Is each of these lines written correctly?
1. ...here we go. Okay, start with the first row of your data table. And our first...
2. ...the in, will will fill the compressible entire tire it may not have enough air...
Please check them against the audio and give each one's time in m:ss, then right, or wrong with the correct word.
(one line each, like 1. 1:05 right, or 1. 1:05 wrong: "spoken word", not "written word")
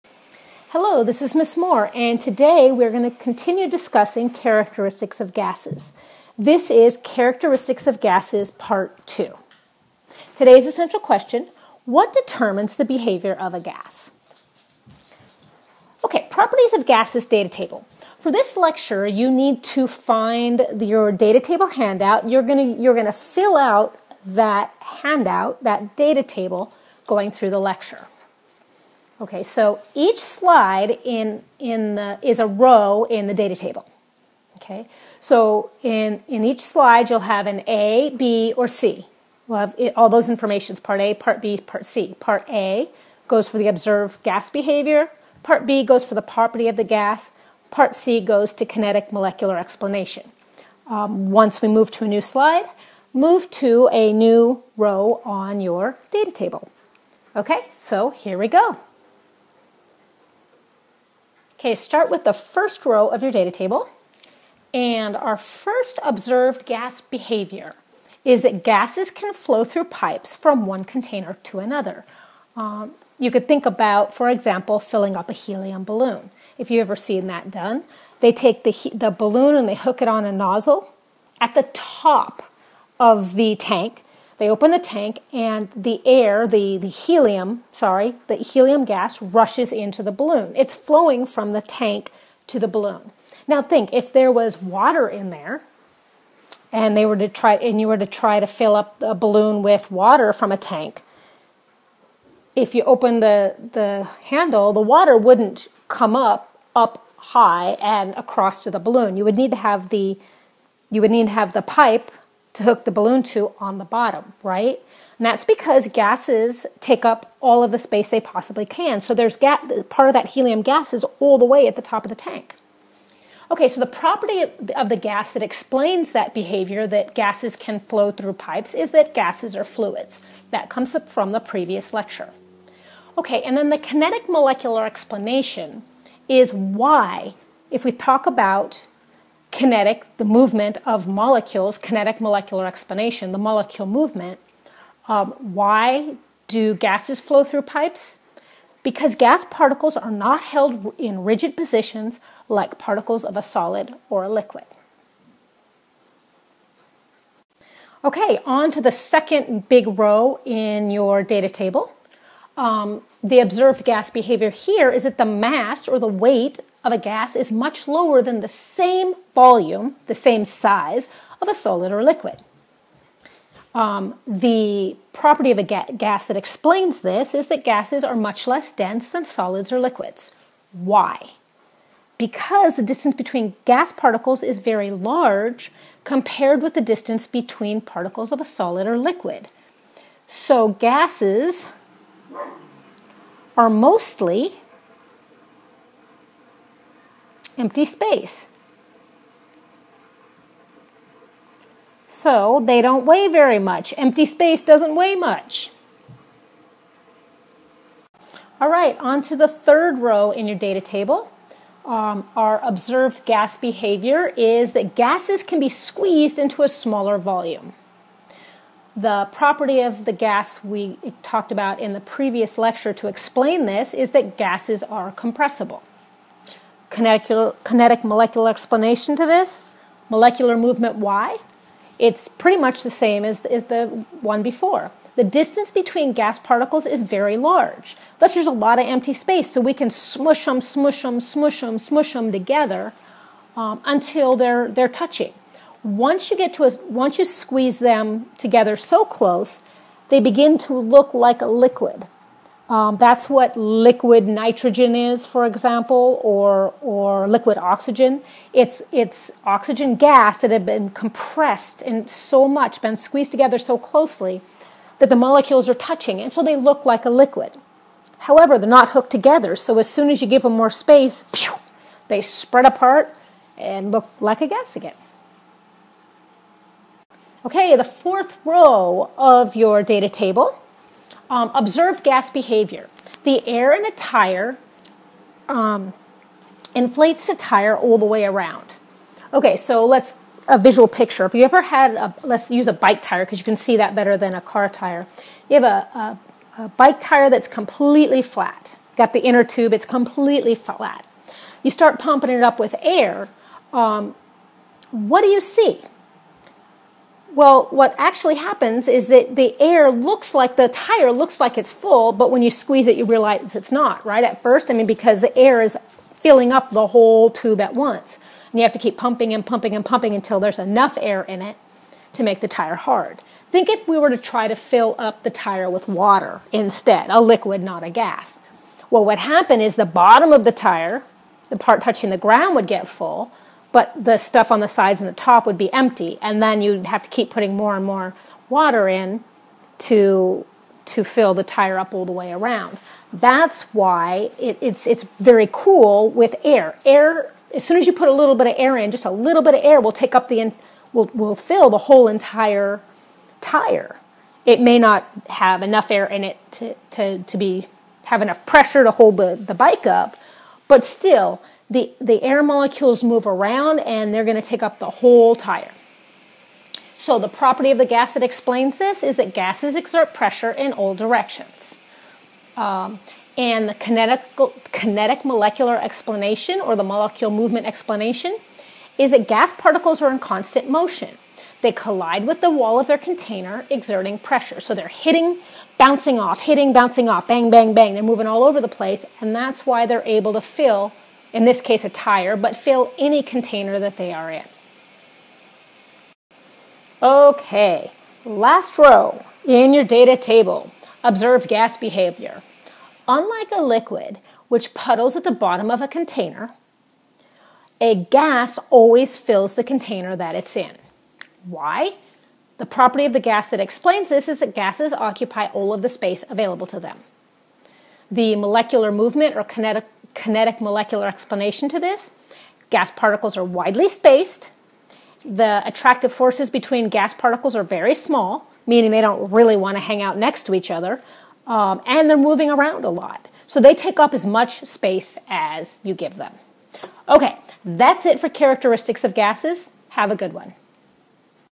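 1. 0:58 right
2. 5:50 wrong: "whole", not "compressible".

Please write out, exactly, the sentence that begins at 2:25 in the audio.
Um, why do gases flow through pipes?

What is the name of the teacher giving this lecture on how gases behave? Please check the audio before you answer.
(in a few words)
Ms. Moore.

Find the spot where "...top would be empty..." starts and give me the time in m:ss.
5:35.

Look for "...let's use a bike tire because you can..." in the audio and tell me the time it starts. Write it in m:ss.
4:52.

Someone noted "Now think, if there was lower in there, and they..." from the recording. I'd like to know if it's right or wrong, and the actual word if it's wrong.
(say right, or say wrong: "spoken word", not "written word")
wrong: "water", not "lower".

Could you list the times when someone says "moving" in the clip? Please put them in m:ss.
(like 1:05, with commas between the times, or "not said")
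6:28, 7:12.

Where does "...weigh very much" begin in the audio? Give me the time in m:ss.
3:23.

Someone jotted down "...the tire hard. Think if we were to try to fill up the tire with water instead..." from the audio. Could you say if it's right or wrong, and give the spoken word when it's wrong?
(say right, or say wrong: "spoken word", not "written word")
right.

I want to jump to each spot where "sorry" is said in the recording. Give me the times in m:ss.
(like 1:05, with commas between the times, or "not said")
1:27.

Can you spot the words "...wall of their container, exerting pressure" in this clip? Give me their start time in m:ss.
6:22.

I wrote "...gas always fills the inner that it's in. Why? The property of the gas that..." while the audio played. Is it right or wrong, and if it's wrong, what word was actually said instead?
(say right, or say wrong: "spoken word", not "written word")
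wrong: "container", not "inner".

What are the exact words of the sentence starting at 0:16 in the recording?
Okay, properties of gases data table.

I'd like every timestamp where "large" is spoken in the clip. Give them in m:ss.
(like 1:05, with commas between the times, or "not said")
3:04, 3:57.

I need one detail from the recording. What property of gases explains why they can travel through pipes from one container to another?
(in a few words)
Gases are fluids.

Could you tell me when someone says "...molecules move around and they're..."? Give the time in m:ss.
6:02.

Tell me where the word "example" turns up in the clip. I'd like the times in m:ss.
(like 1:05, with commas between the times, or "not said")
1:14, 4:15.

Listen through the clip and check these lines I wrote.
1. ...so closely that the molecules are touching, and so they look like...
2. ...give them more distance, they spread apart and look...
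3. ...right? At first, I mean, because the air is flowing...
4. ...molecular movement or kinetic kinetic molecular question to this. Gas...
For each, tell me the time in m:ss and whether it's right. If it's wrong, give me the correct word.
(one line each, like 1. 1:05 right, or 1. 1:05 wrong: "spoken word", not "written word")
1. 4:23 right
2. 4:30 wrong: "space", not "distance"
3. 5:14 wrong: "filling", not "flowing"
4. 6:58 wrong: "explanation", not "question".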